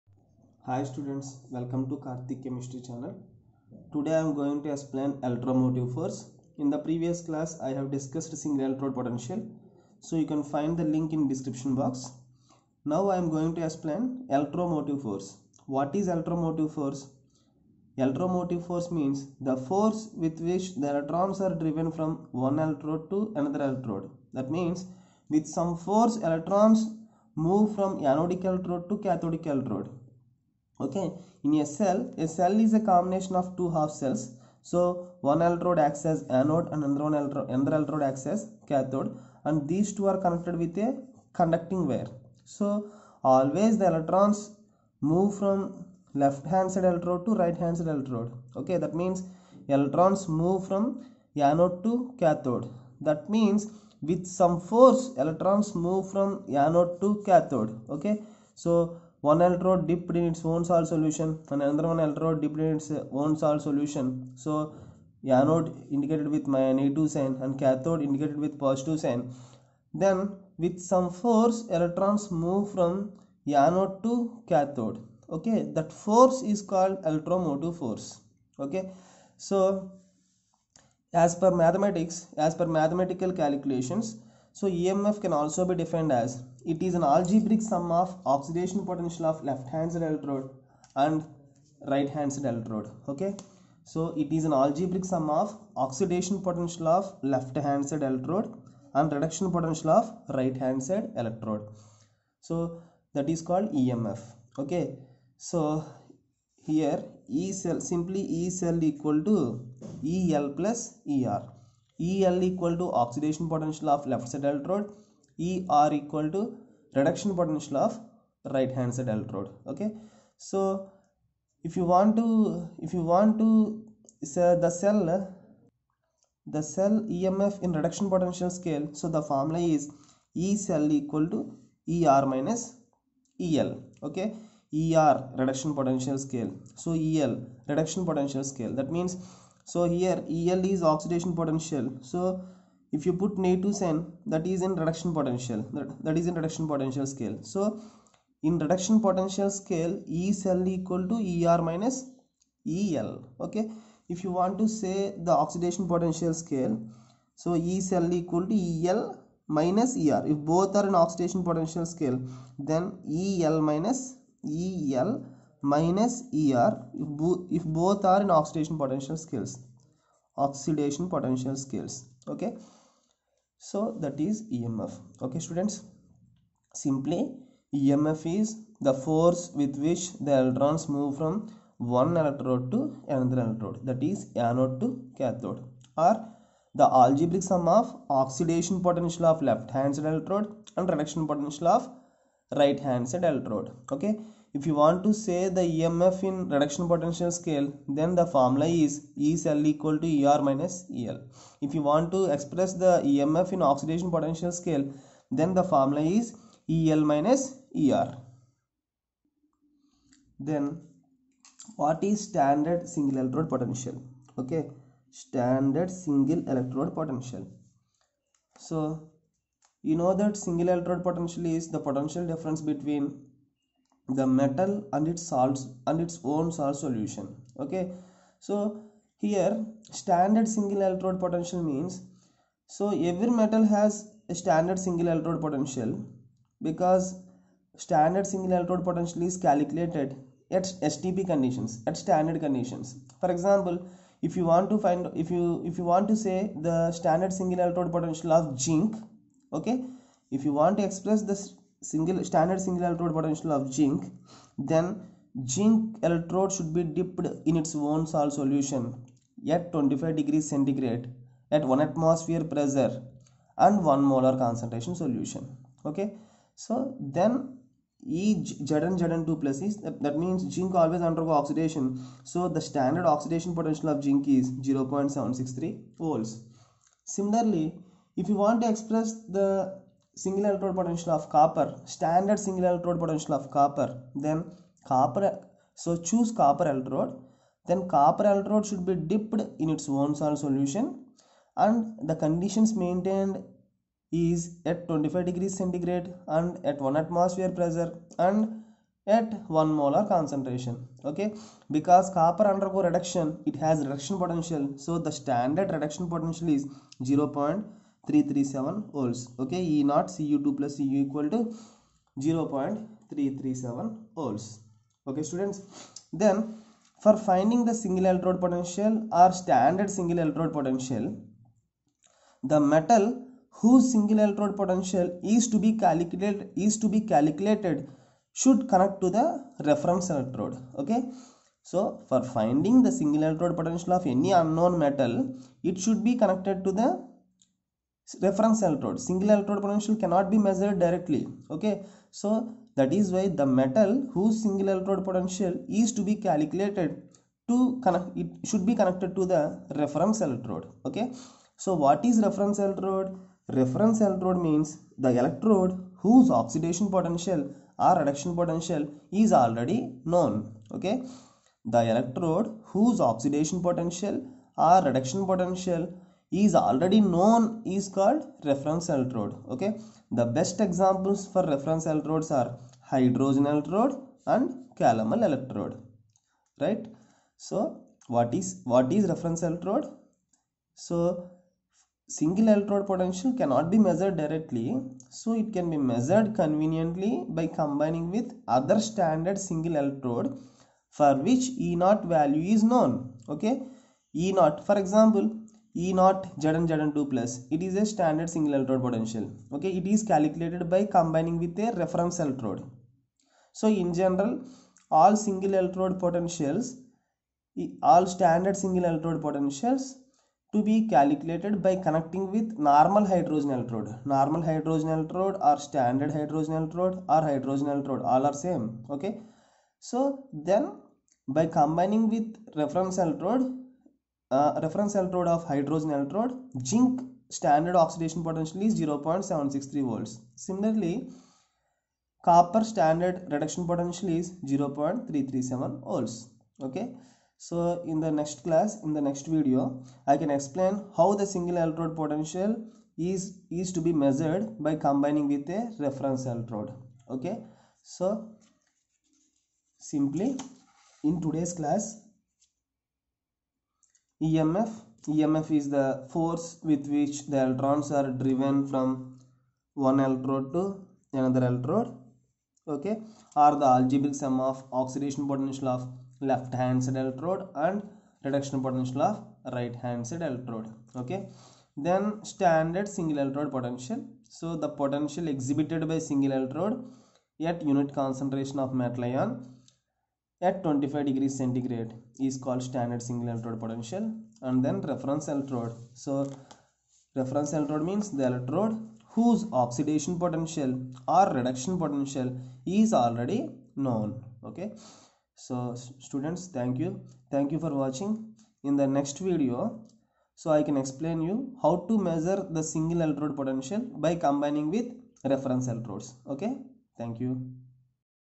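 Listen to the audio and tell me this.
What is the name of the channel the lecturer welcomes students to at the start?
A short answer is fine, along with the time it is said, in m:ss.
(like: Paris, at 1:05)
Karthik Chemistry, at 0:01.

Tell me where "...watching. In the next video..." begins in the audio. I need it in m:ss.
8:17.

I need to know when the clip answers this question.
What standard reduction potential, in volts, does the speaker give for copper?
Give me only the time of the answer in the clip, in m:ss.
5:07.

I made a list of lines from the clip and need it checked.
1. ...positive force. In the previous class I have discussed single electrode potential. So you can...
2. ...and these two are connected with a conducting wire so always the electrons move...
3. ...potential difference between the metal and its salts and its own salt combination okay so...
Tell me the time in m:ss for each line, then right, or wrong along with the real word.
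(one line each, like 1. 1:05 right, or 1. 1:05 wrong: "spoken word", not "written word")
1. 0:05 wrong: "electromotive", not "positive"
2. 0:39 right
3. 3:41 wrong: "solution", not "combination".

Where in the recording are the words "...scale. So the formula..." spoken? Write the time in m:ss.
2:08.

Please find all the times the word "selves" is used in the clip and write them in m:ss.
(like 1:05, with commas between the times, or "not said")
not said.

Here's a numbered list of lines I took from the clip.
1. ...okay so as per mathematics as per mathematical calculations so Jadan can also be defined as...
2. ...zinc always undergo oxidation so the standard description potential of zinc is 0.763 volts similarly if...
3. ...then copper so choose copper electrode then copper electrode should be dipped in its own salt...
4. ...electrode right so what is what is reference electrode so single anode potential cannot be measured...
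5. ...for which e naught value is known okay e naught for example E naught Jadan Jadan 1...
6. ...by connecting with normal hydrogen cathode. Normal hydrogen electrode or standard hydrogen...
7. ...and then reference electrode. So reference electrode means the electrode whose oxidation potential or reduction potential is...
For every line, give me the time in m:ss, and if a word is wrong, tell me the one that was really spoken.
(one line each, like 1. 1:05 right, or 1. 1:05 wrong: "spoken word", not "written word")
1. 1:18 wrong: "EMF", not "Jadan"
2. 4:30 wrong: "oxidation", not "description"
3. 4:44 right
4. 6:15 wrong: "electrode", not "anode"
5. 6:30 wrong: "2", not "1"
6. 6:51 wrong: "electrode", not "cathode"
7. 8:04 right.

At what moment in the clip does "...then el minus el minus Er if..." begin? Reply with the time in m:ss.
2:42.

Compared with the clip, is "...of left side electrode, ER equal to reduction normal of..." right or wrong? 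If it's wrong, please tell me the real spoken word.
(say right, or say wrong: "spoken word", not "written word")
wrong: "potential", not "normal".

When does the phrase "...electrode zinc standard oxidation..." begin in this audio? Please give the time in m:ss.
7:05.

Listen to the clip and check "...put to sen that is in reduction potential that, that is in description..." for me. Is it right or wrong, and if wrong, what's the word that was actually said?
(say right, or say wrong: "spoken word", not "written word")
wrong: "reduction", not "description".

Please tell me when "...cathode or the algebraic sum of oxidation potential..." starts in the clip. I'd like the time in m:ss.
3:05.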